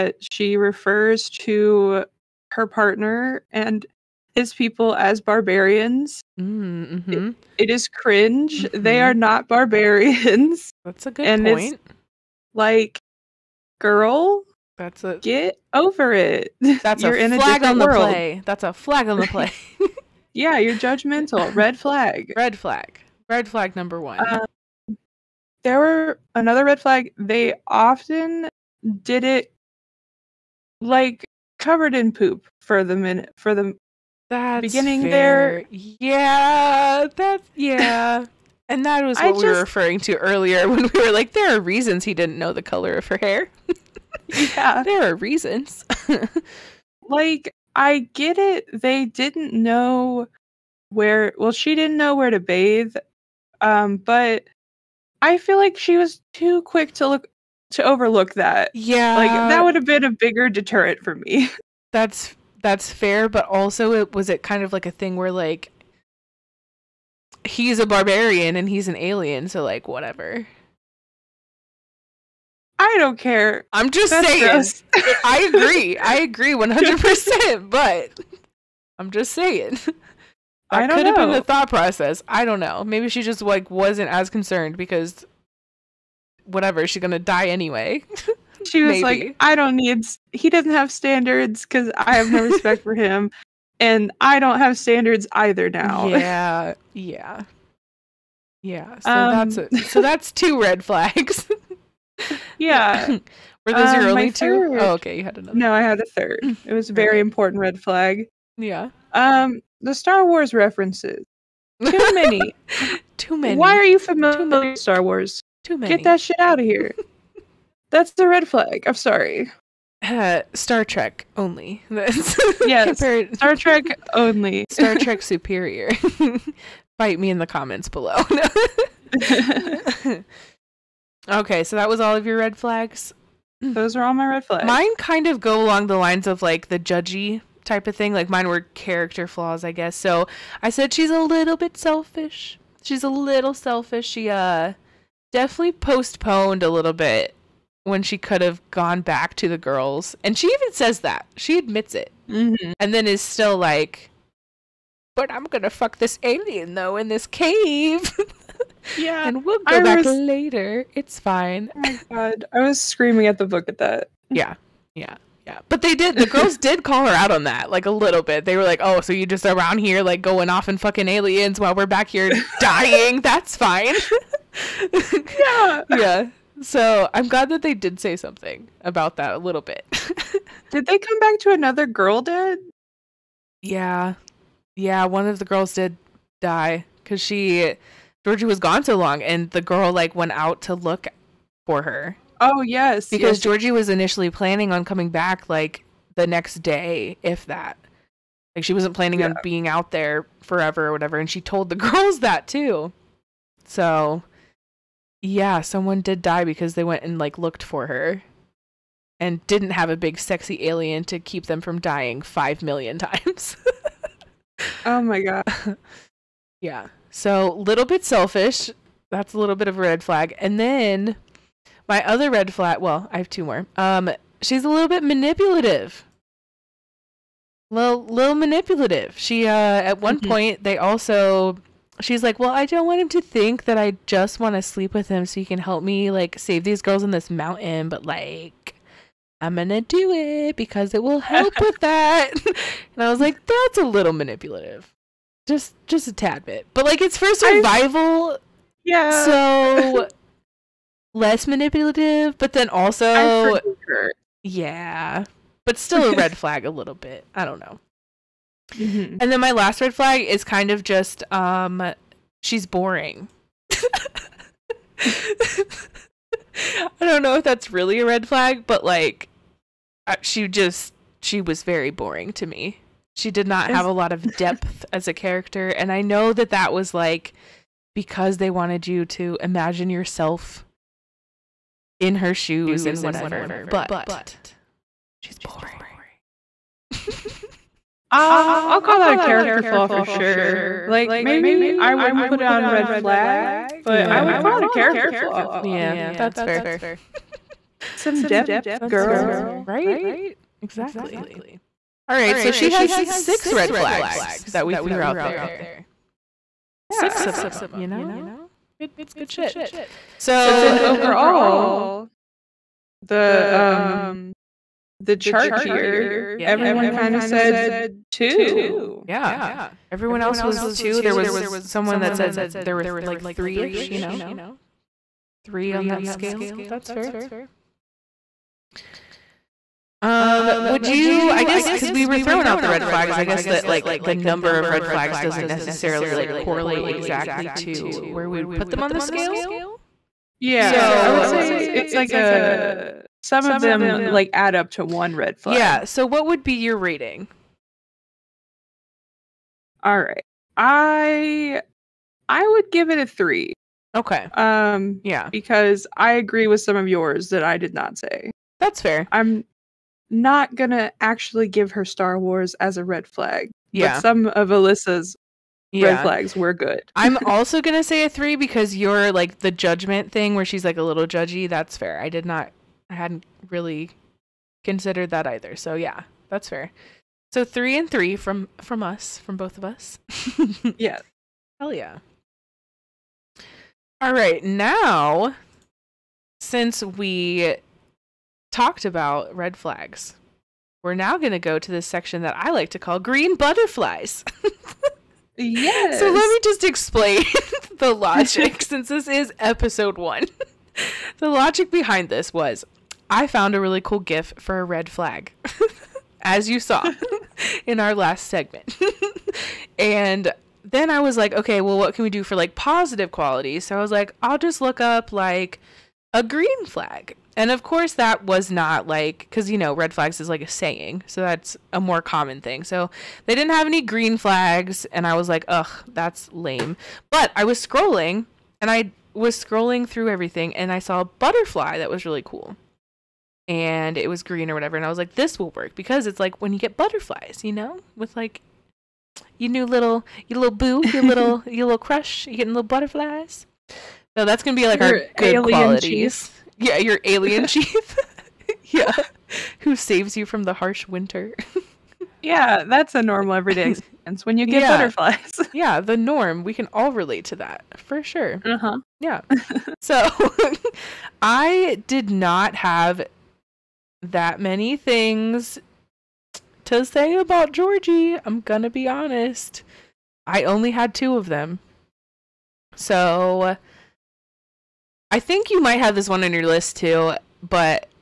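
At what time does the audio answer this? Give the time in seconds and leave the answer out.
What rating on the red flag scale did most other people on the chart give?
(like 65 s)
319 s.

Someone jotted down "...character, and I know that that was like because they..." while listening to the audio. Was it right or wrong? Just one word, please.
right.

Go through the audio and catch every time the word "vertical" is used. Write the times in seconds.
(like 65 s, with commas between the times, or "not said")
not said.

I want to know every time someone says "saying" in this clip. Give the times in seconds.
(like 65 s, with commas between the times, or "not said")
74 s, 79 s, 420 s.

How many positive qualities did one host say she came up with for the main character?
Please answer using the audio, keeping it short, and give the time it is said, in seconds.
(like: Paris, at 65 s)
2, at 470 s.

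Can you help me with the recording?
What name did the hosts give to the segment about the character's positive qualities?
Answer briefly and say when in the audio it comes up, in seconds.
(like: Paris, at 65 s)
Green butterflies, at 392 s.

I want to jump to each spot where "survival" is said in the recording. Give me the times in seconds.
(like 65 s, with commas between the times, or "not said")
247 s.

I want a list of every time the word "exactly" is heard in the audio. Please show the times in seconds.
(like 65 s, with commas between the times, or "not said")
300 s, 336 s.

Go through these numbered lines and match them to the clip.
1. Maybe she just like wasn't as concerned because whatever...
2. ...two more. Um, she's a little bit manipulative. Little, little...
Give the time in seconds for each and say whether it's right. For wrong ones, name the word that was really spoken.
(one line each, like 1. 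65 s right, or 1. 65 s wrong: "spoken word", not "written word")
1. 82 s right
2. 223 s right.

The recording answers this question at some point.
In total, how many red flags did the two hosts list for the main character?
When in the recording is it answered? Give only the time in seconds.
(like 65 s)
303 s.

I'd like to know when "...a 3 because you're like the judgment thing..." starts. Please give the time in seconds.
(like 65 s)
368 s.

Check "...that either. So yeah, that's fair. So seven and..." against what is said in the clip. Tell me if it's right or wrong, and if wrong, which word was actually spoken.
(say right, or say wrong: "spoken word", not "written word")
wrong: "three", not "seven".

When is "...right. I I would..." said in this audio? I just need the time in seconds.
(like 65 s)
350 s.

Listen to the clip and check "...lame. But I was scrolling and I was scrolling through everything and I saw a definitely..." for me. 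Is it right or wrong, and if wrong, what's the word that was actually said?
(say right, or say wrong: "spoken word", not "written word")
wrong: "butterfly", not "definitely".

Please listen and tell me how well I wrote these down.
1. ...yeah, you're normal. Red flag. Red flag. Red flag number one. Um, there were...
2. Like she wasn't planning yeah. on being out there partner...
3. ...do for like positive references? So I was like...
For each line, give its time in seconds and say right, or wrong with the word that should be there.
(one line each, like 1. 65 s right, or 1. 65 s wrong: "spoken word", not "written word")
1. 20 s wrong: "judgmental", not "normal"
2. 198 s wrong: "forever", not "partner"
3. 412 s wrong: "qualities", not "references".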